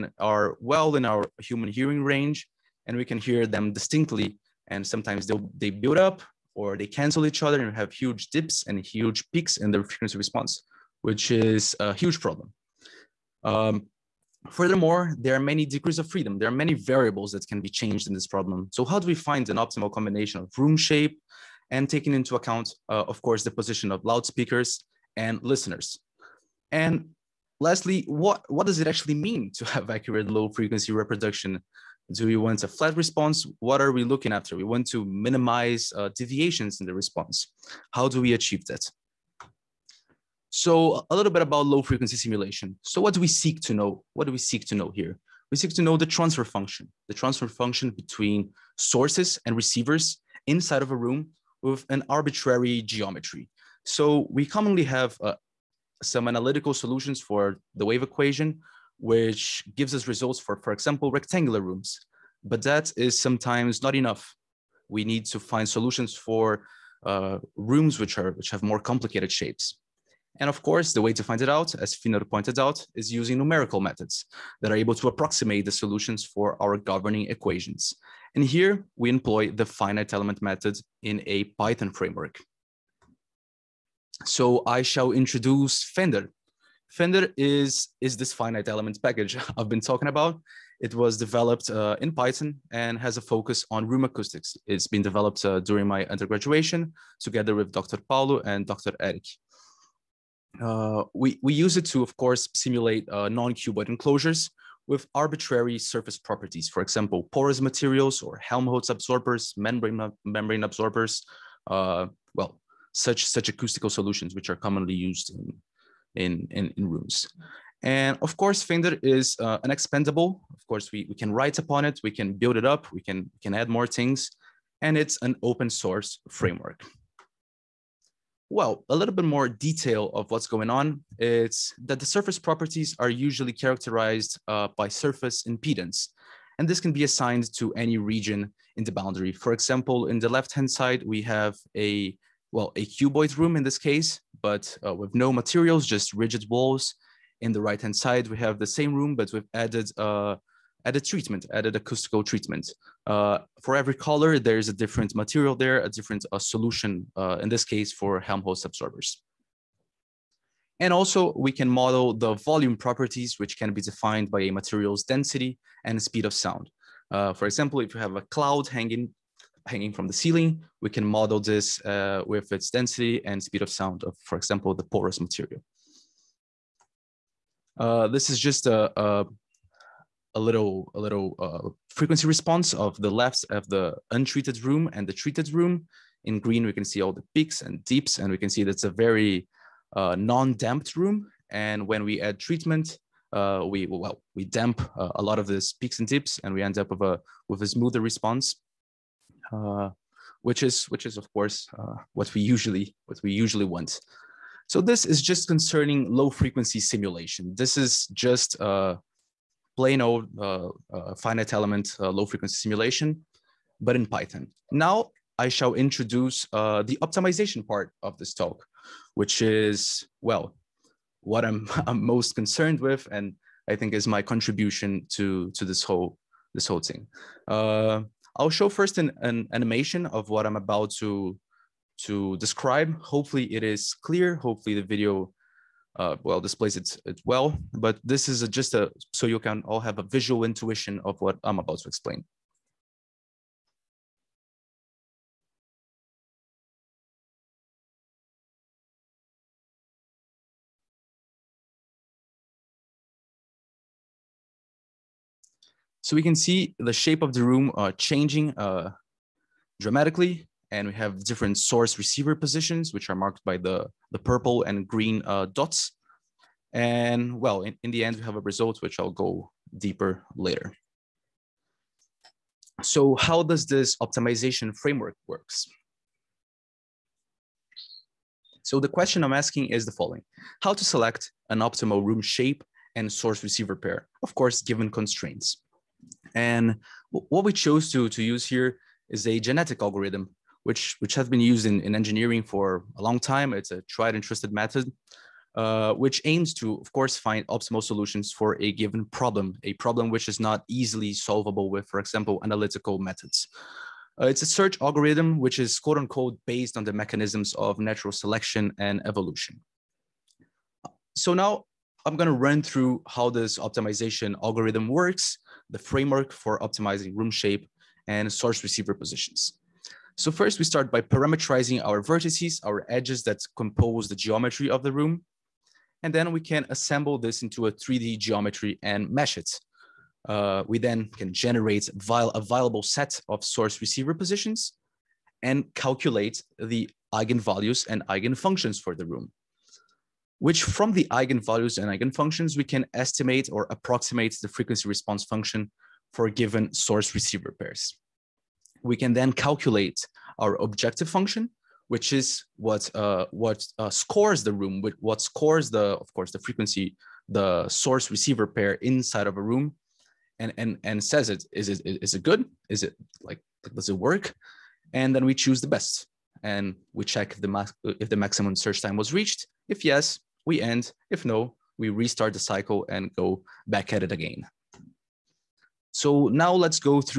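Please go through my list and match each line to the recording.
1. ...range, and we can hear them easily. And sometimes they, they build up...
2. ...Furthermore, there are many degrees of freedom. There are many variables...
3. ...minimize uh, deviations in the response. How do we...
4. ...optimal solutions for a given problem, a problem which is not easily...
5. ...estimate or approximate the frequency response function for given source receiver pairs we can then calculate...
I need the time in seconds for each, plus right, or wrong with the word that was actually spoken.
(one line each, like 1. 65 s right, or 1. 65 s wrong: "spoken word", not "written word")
1. 2 s wrong: "distinctly", not "easily"
2. 14 s right
3. 35 s right
4. 297 s right
5. 342 s right.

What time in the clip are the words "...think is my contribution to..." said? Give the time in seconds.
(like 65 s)
223 s.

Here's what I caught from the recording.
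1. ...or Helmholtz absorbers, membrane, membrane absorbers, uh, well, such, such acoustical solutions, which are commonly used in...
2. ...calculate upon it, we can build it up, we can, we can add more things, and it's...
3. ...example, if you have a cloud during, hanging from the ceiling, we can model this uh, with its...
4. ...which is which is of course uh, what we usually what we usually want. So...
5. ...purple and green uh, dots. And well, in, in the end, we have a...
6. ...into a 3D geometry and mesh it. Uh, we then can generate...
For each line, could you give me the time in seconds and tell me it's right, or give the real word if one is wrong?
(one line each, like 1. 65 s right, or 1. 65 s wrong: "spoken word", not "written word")
1. 108 s right
2. 121 s wrong: "write", not "calculate"
3. 167 s wrong: "hanging", not "during"
4. 200 s right
5. 264 s right
6. 327 s right.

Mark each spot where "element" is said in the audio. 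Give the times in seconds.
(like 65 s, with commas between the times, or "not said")
80 s, 88 s, 211 s.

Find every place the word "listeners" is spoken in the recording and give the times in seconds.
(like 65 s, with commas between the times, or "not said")
25 s.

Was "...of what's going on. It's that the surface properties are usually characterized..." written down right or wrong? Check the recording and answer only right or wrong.
right.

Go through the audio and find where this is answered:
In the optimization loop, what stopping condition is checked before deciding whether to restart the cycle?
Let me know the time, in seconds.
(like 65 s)
368 s.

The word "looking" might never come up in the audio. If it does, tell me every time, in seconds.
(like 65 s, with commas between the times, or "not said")
34 s.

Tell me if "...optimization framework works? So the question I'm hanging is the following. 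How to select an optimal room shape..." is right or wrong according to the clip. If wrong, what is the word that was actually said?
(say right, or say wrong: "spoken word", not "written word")
wrong: "asking", not "hanging".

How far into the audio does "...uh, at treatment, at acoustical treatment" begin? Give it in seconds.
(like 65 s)
149 s.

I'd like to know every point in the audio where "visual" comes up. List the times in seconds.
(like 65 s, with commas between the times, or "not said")
240 s.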